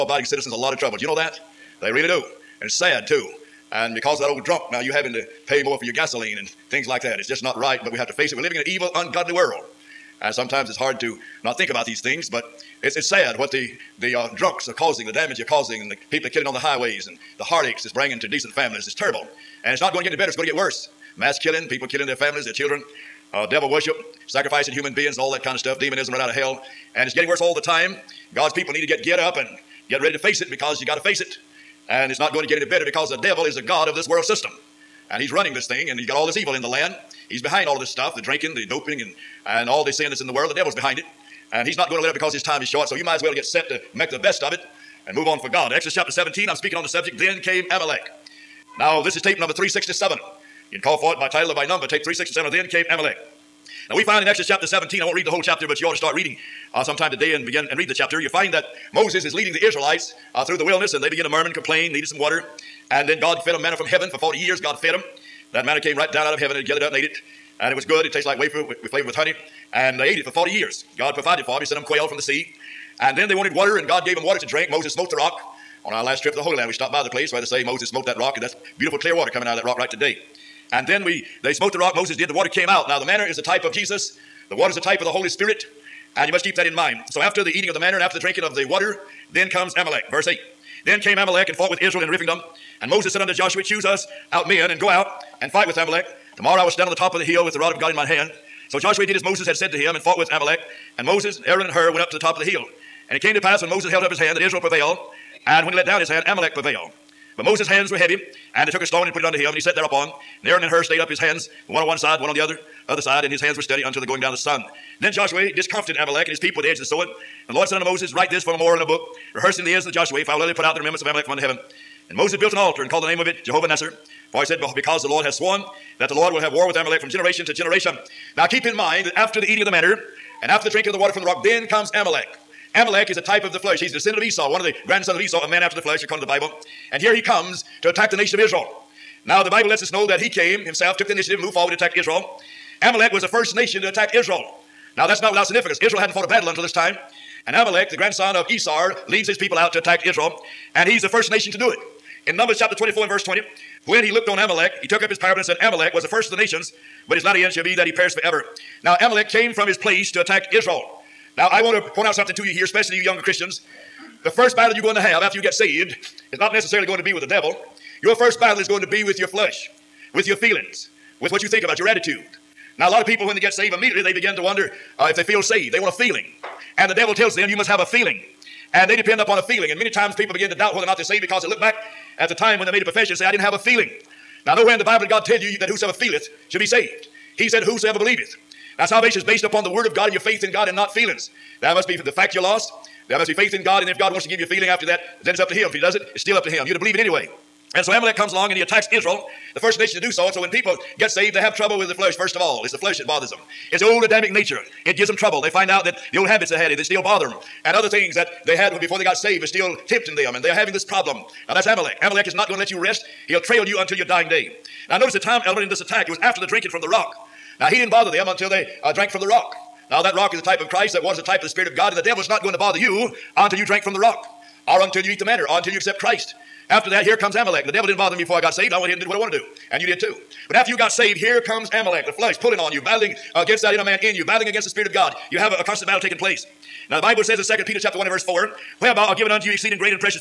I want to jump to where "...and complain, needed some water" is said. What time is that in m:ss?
1:01.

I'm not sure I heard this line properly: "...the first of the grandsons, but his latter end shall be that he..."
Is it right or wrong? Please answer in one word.
wrong.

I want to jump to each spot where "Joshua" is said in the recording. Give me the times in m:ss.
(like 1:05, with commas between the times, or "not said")
1:33, 1:38, 1:55, 1:59.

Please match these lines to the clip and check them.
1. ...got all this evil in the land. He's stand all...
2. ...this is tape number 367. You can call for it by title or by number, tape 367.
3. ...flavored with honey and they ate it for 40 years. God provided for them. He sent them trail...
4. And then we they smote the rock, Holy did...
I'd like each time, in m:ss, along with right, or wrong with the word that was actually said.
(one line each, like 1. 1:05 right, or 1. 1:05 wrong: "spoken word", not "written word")
1. 0:36 wrong: "behind", not "stand"
2. 0:49 right
3. 1:08 wrong: "quail", not "trail"
4. 1:20 wrong: "Moses", not "Holy".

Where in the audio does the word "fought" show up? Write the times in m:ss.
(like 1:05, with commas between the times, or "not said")
1:31, 1:39, 2:26.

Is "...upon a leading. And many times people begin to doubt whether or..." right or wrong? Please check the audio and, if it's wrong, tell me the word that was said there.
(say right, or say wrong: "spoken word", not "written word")
wrong: "feeling", not "leading".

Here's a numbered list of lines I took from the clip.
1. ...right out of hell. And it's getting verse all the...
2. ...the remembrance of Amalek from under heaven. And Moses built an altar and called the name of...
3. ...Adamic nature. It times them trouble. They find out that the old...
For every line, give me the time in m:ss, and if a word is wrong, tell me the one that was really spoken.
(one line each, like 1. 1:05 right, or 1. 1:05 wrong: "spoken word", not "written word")
1. 0:26 wrong: "worse", not "verse"
2. 2:00 right
3. 3:24 wrong: "gives", not "times".